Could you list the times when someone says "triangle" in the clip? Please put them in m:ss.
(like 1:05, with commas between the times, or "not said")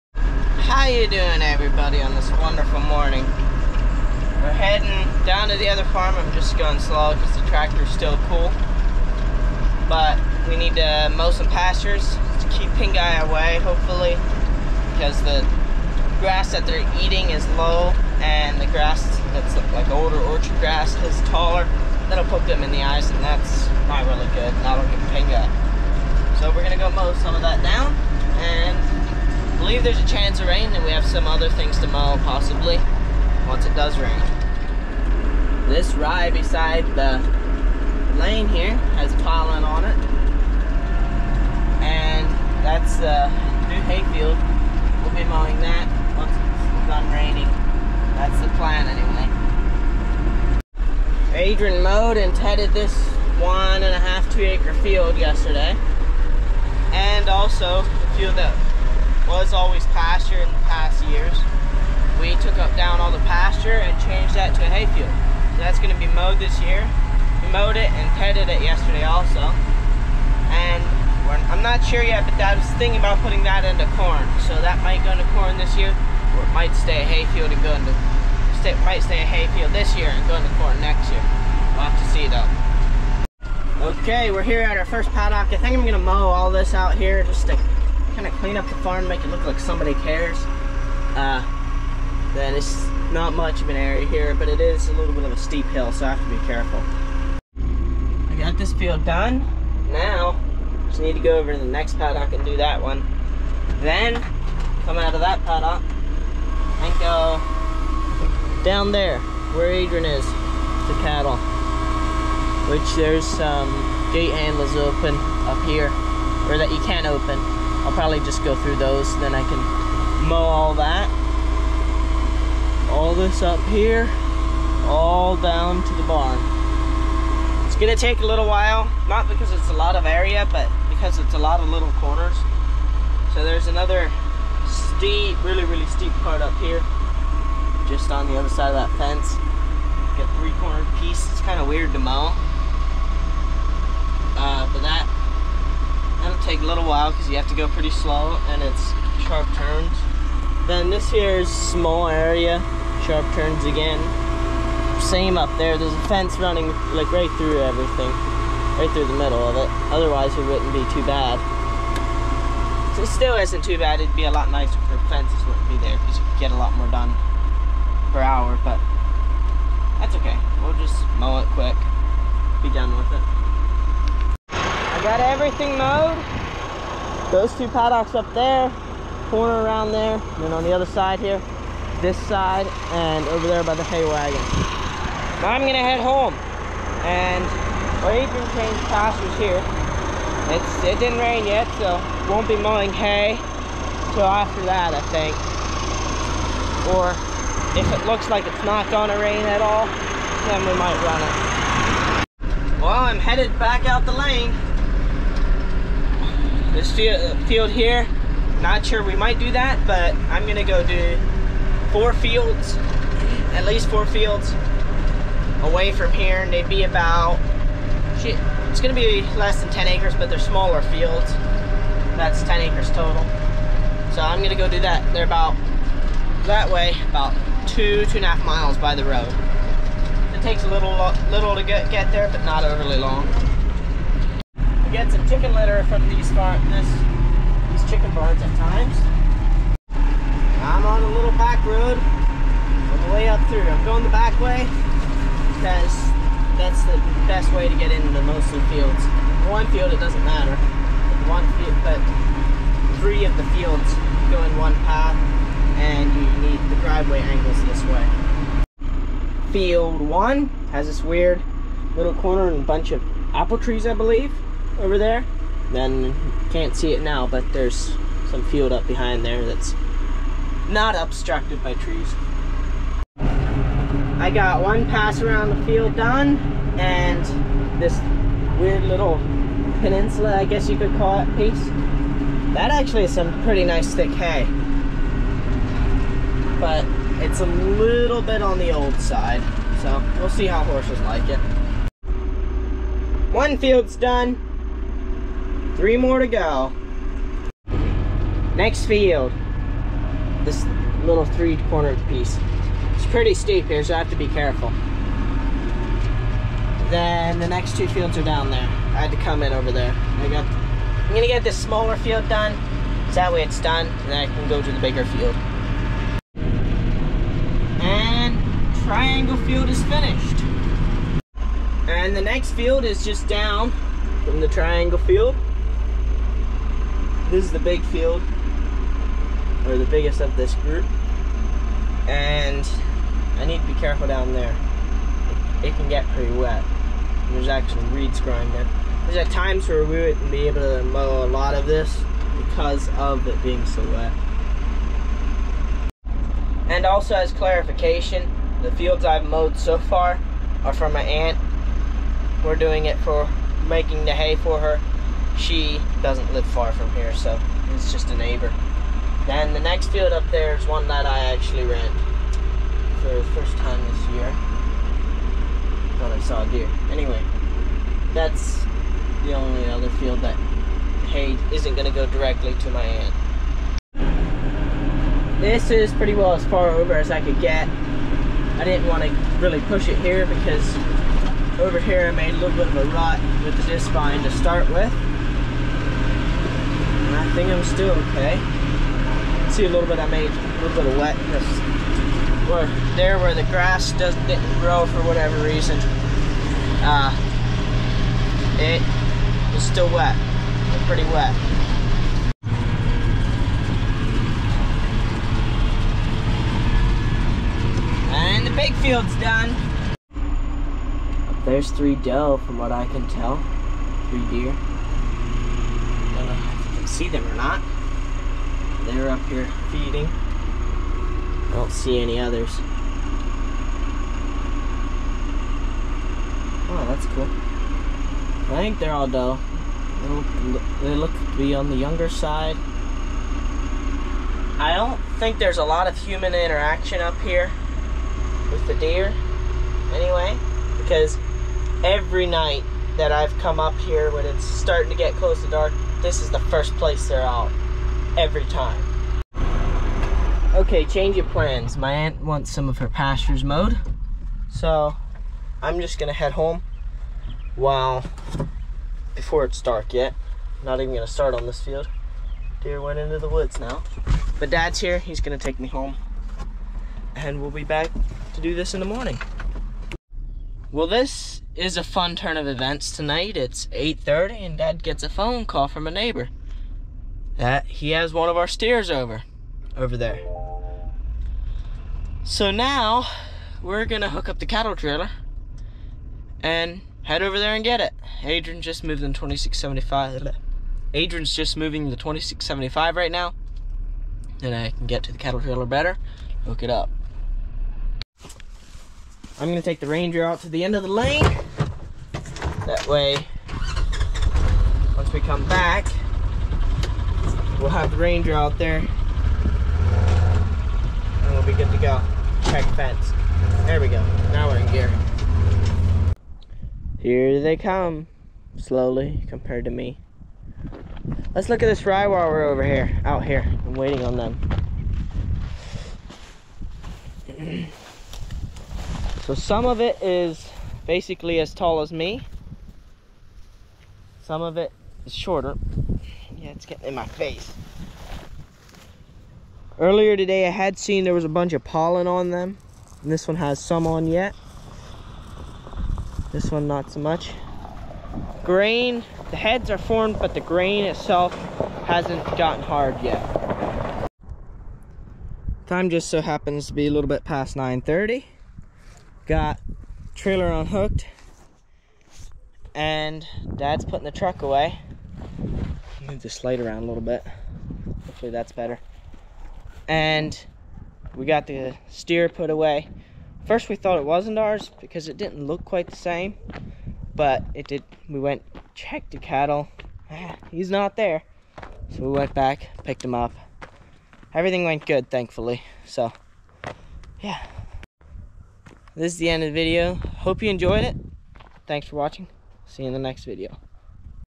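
5:18, 5:24.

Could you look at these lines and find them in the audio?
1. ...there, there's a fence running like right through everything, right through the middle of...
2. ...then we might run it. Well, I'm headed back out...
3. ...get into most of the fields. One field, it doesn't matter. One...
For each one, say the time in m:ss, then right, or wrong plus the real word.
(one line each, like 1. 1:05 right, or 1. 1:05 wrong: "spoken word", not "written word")
1. 2:35 right
2. 3:20 right
3. 4:07 right.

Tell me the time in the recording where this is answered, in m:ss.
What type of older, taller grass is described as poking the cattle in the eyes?
0:20.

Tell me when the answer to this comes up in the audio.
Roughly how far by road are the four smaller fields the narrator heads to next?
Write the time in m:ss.
3:47.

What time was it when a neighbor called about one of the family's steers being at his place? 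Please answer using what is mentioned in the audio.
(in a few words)
8:30.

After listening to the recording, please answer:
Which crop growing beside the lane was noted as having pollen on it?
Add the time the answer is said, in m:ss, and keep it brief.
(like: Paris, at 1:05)
Rye, at 0:35.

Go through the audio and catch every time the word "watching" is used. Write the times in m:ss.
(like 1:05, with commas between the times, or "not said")
9:51.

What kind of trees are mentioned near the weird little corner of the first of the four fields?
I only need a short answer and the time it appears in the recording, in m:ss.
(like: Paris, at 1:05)
Apple trees, at 4:23.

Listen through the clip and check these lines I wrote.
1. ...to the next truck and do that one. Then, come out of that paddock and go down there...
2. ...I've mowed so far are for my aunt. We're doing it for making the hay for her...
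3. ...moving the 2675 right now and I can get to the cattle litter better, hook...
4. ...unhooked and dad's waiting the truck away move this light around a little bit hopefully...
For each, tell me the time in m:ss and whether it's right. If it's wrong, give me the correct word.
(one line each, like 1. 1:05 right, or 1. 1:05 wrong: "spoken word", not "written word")
1. 1:41 wrong: "paddock", not "truck"
2. 5:49 right
3. 8:11 wrong: "trailer", not "litter"
4. 9:20 wrong: "putting", not "waiting".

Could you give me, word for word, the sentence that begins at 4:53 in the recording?
One field's done, Three more to go.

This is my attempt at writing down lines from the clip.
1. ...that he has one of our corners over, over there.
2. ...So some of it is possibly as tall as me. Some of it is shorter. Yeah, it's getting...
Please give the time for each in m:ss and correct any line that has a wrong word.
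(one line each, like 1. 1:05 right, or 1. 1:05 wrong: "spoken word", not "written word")
1. 7:57 wrong: "steers", not "corners"
2. 8:49 wrong: "basically", not "possibly".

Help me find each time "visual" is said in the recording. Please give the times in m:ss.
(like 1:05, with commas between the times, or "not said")
not said.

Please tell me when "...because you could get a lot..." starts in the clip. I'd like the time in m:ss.
2:45.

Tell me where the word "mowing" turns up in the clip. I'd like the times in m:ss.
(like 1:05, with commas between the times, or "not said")
0:45, 3:12.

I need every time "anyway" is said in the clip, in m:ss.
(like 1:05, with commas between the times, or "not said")
0:48, 6:06, 7:19.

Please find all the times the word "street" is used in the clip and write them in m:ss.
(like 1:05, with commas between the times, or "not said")
not said.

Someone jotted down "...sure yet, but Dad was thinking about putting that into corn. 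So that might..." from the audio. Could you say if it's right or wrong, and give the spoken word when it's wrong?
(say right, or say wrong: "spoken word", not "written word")
right.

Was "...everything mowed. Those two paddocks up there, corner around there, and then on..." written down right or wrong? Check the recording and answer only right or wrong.
right.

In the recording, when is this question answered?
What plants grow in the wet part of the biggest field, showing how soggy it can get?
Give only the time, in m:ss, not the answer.
5:37.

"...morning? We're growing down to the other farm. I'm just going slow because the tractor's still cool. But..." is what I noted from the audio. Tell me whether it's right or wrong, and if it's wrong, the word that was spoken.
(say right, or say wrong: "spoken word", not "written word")
wrong: "heading", not "growing".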